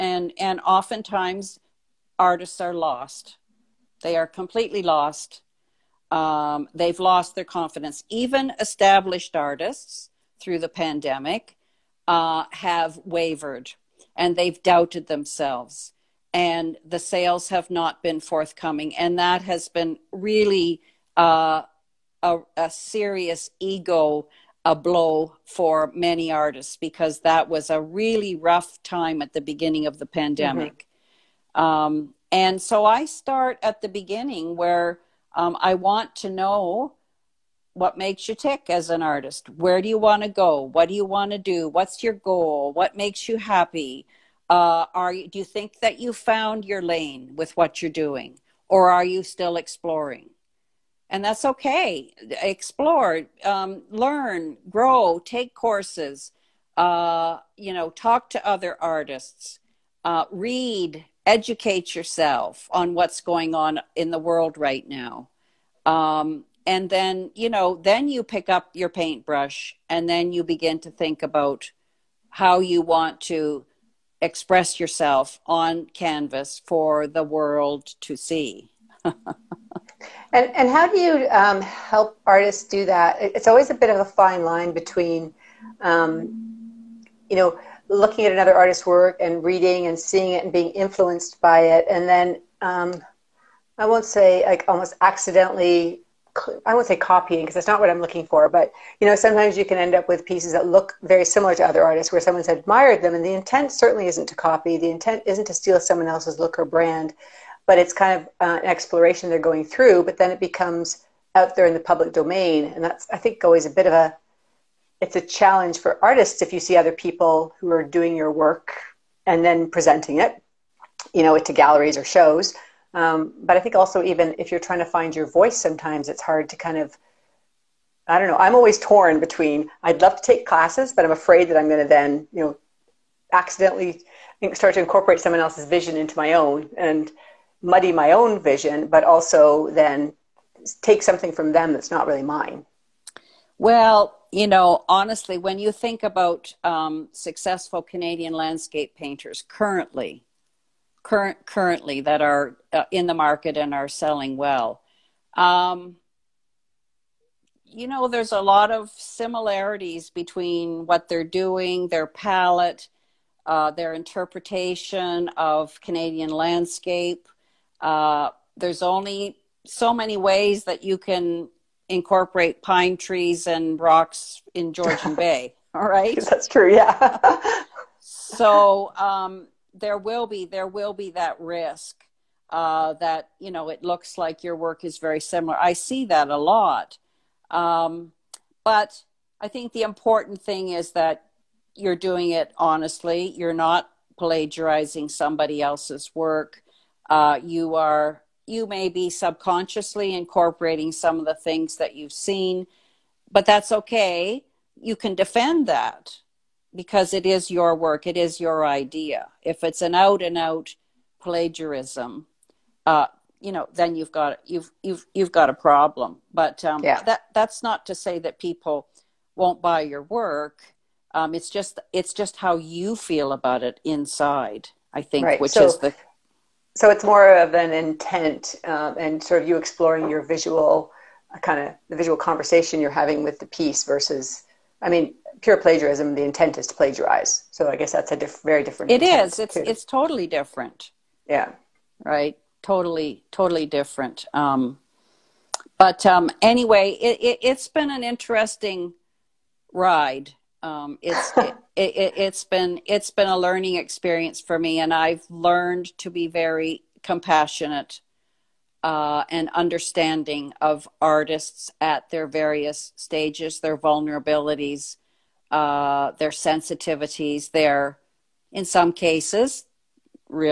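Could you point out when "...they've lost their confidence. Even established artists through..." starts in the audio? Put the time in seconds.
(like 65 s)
6 s.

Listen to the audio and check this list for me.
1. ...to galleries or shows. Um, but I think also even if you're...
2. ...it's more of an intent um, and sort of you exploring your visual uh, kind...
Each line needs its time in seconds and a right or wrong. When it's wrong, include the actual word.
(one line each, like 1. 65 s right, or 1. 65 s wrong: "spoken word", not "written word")
1. 121 s right
2. 226 s right.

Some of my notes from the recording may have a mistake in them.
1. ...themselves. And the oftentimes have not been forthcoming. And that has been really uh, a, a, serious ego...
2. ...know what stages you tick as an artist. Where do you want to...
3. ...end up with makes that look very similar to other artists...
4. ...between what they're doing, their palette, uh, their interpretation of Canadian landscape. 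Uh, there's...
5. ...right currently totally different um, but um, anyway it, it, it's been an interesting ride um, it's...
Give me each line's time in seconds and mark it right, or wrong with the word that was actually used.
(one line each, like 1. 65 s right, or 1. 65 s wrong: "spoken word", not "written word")
1. 15 s wrong: "sales", not "oftentimes"
2. 36 s wrong: "makes", not "stages"
3. 99 s wrong: "pieces", not "makes"
4. 160 s right
5. 242 s wrong: "totally", not "currently".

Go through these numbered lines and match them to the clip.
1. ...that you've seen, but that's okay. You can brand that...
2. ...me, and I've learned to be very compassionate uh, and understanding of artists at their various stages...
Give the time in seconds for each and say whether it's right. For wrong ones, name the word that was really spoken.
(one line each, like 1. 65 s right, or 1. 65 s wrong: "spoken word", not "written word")
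1. 201 s wrong: "defend", not "brand"
2. 254 s right.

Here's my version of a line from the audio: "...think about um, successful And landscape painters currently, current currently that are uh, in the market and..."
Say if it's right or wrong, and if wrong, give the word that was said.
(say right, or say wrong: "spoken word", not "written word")
wrong: "Canadian", not "And".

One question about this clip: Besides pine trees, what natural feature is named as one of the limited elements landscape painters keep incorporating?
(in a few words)
rocks.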